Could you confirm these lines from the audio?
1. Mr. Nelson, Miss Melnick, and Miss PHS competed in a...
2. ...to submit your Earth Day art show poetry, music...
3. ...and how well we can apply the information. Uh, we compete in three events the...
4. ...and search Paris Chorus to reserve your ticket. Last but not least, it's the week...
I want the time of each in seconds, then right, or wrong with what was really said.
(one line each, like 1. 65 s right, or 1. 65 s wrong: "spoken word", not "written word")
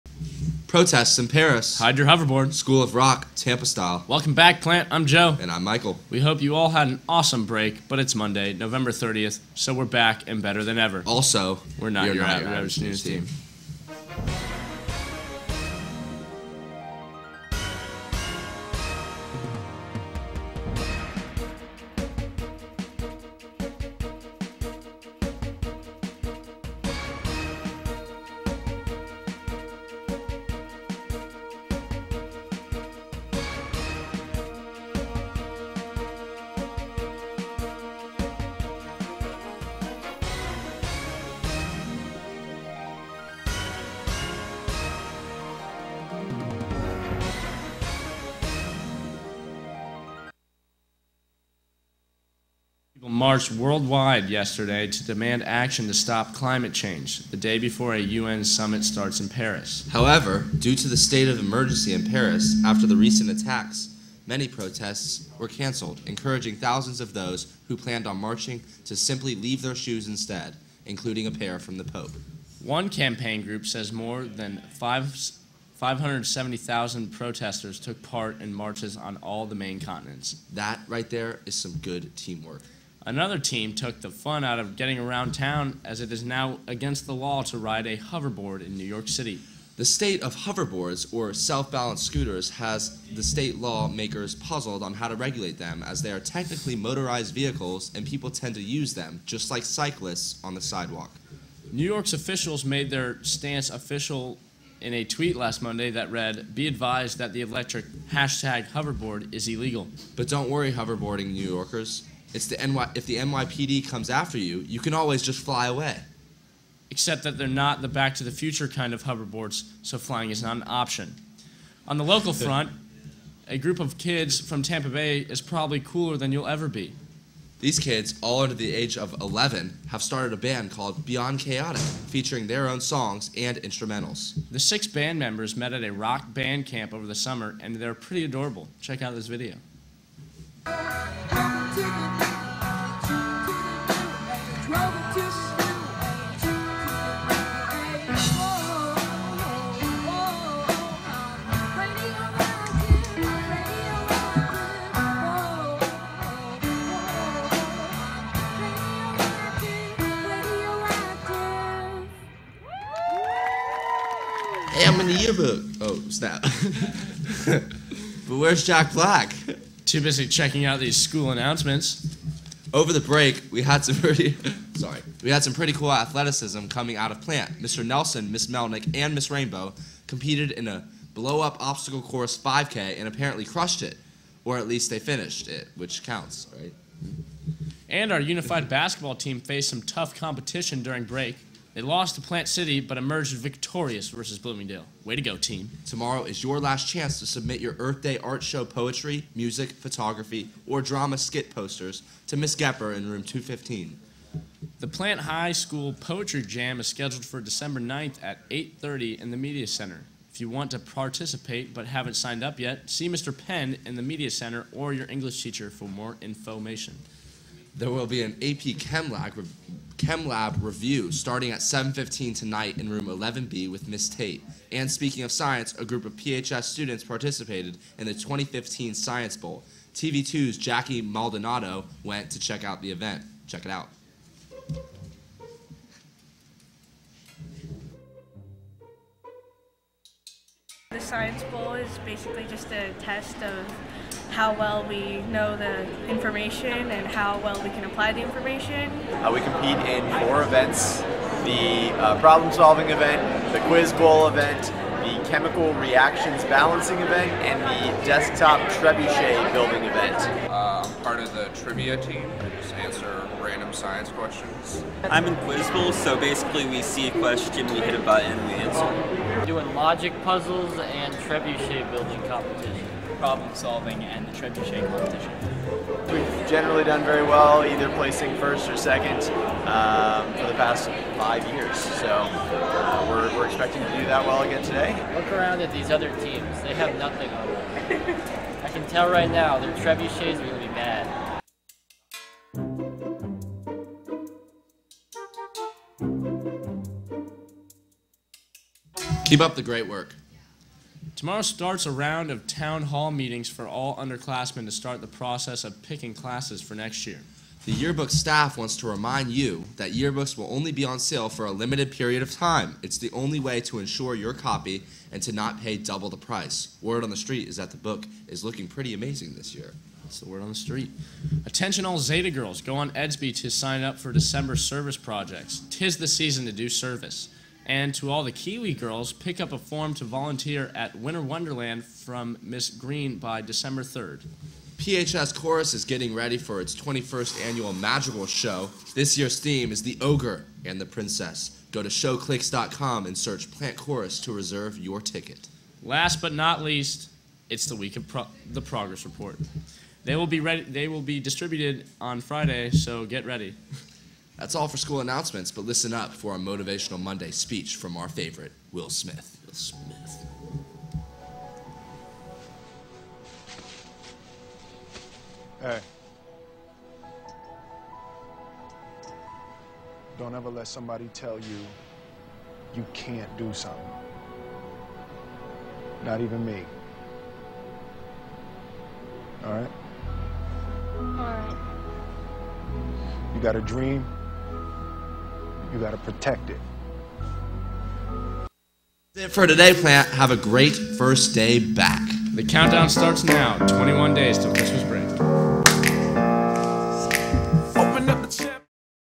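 1. 177 s wrong: "Rainbow", not "PHS"
2. 197 s right
3. 246 s wrong: "four", not "three"
4. 343 s wrong: "Plant", not "Paris".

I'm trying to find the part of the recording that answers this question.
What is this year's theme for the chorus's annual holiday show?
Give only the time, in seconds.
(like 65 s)
339 s.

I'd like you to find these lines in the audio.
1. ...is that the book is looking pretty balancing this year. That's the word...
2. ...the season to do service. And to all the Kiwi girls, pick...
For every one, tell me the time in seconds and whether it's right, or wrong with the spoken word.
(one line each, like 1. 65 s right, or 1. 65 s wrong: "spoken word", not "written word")
1. 317 s wrong: "amazing", not "balancing"
2. 325 s right.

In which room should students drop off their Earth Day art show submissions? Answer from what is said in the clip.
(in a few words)
Room 215.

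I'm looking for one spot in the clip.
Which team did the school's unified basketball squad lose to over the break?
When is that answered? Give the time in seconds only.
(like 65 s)
192 s.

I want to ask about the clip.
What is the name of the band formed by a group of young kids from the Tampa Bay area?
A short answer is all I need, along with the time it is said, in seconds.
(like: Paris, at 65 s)
Beyond Chaotic, at 131 s.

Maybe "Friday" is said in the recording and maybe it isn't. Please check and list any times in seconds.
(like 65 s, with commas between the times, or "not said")
352 s.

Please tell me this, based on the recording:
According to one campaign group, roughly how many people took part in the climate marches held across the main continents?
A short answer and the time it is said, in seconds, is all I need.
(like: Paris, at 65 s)
570,000, at 74 s.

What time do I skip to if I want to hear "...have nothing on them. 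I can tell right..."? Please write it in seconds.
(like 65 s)
286 s.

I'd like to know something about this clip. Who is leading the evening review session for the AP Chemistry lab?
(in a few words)
Miss Tate.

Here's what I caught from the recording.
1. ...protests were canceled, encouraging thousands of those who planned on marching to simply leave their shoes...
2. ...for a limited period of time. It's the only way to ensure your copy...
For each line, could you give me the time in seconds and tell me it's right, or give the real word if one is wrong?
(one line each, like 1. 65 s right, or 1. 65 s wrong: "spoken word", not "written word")
1. 64 s right
2. 311 s right.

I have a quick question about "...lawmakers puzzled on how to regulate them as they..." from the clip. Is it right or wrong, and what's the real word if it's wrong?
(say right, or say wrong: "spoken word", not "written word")
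right.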